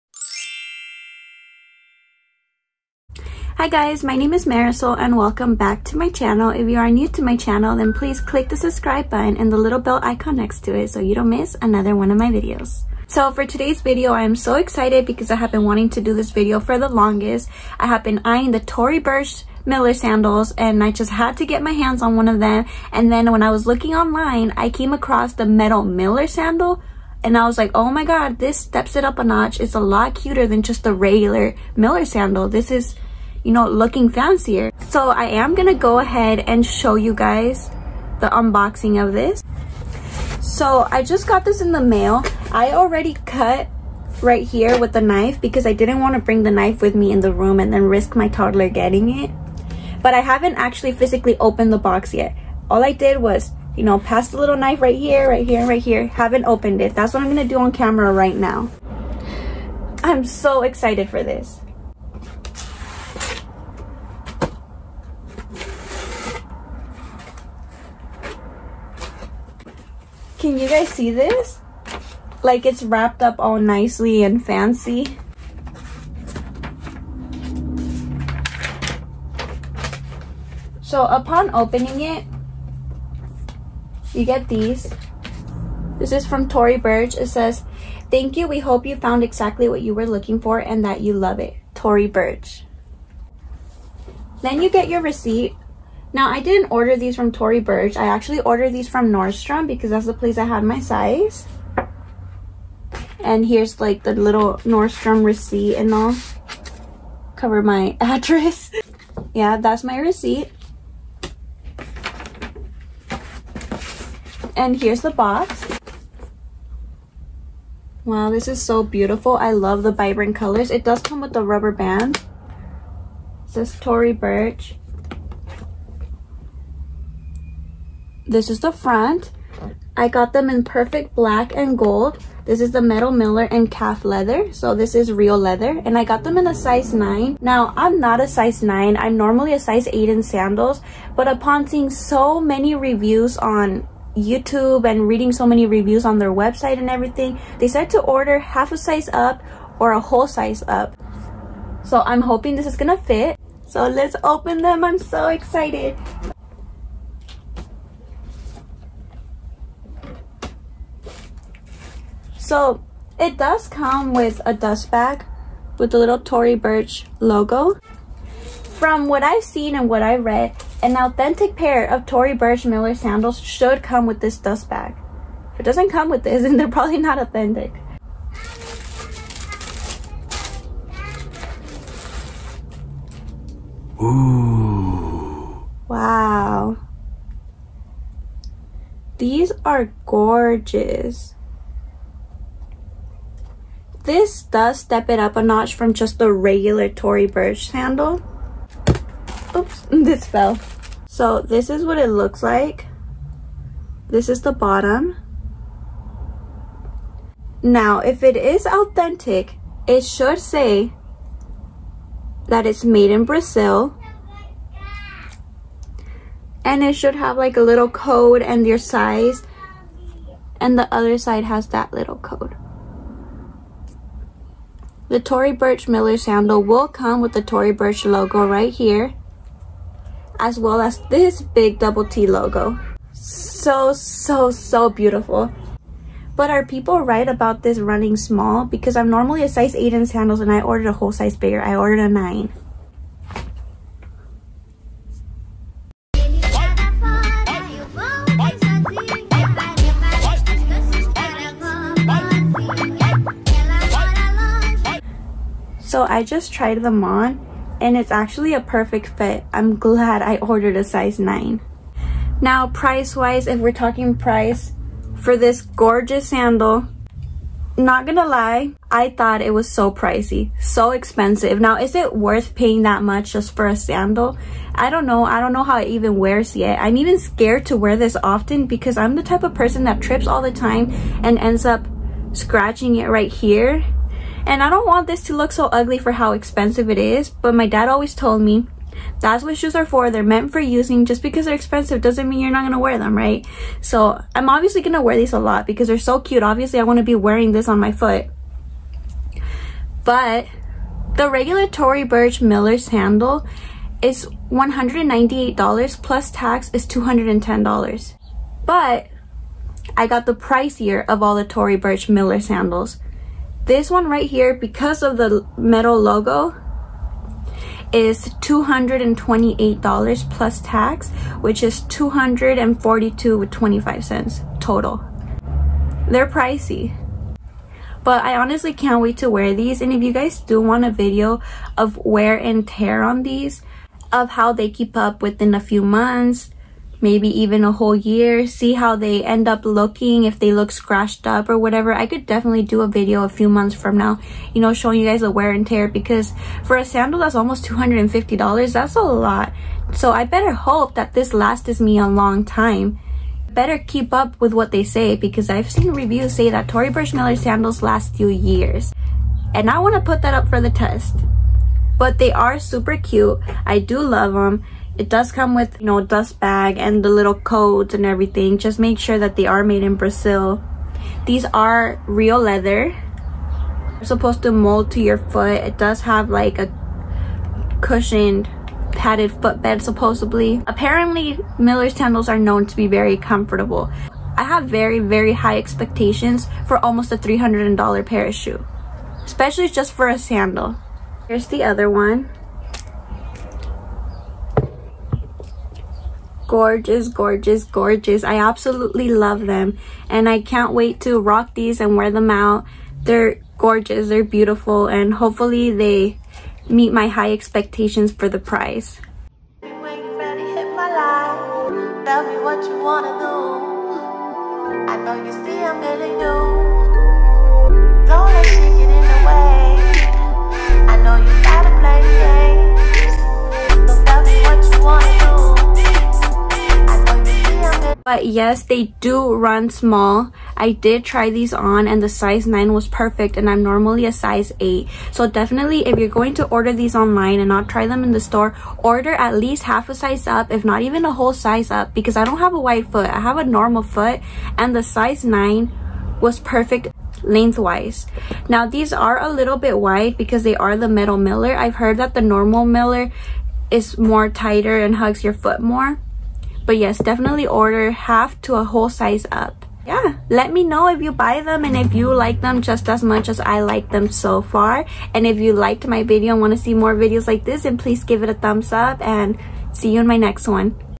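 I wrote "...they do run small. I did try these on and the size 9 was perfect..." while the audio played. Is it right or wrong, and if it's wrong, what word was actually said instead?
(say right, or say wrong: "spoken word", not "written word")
right.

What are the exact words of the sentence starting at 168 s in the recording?
From what I've seen and what I read, an authentic pair of Tory Burch Miller sandals should come with this dust bag.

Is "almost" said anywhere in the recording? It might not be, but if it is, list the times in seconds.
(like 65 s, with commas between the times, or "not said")
347 s, 386 s.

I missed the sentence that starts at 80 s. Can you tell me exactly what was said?
So upon opening it, you get these.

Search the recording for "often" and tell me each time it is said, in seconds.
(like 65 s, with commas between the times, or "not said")
278 s.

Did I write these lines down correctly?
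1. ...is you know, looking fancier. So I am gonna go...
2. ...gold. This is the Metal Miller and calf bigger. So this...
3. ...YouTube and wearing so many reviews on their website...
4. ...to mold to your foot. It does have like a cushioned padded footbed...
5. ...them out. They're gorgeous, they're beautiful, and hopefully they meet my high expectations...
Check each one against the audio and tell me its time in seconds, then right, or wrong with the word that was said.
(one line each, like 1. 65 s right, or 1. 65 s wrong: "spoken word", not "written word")
1. 32 s right
2. 131 s wrong: "leather", not "bigger"
3. 144 s wrong: "reading", not "wearing"
4. 374 s right
5. 402 s right.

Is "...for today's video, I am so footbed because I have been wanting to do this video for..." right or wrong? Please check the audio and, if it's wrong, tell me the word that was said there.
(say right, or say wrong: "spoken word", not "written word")
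wrong: "excited", not "footbed".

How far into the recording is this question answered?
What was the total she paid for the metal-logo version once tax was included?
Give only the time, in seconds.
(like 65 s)
321 s.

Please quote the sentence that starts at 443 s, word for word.
I have a normal foot and the size 9 was perfect lengthwise.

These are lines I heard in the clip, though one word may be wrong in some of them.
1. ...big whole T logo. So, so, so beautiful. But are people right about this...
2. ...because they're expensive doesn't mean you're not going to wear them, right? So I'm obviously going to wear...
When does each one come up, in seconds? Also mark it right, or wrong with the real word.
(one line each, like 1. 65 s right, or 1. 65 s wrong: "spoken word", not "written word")
1. 231 s wrong: "double", not "whole"
2. 291 s right.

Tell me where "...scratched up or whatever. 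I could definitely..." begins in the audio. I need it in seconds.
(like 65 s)
340 s.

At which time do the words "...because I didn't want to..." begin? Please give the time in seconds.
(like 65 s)
45 s.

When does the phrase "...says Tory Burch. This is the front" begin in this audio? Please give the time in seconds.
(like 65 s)
123 s.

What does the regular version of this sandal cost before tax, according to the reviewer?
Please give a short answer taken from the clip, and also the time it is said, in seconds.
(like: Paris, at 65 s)
$198, at 304 s.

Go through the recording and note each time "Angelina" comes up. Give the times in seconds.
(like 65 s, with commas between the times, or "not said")
not said.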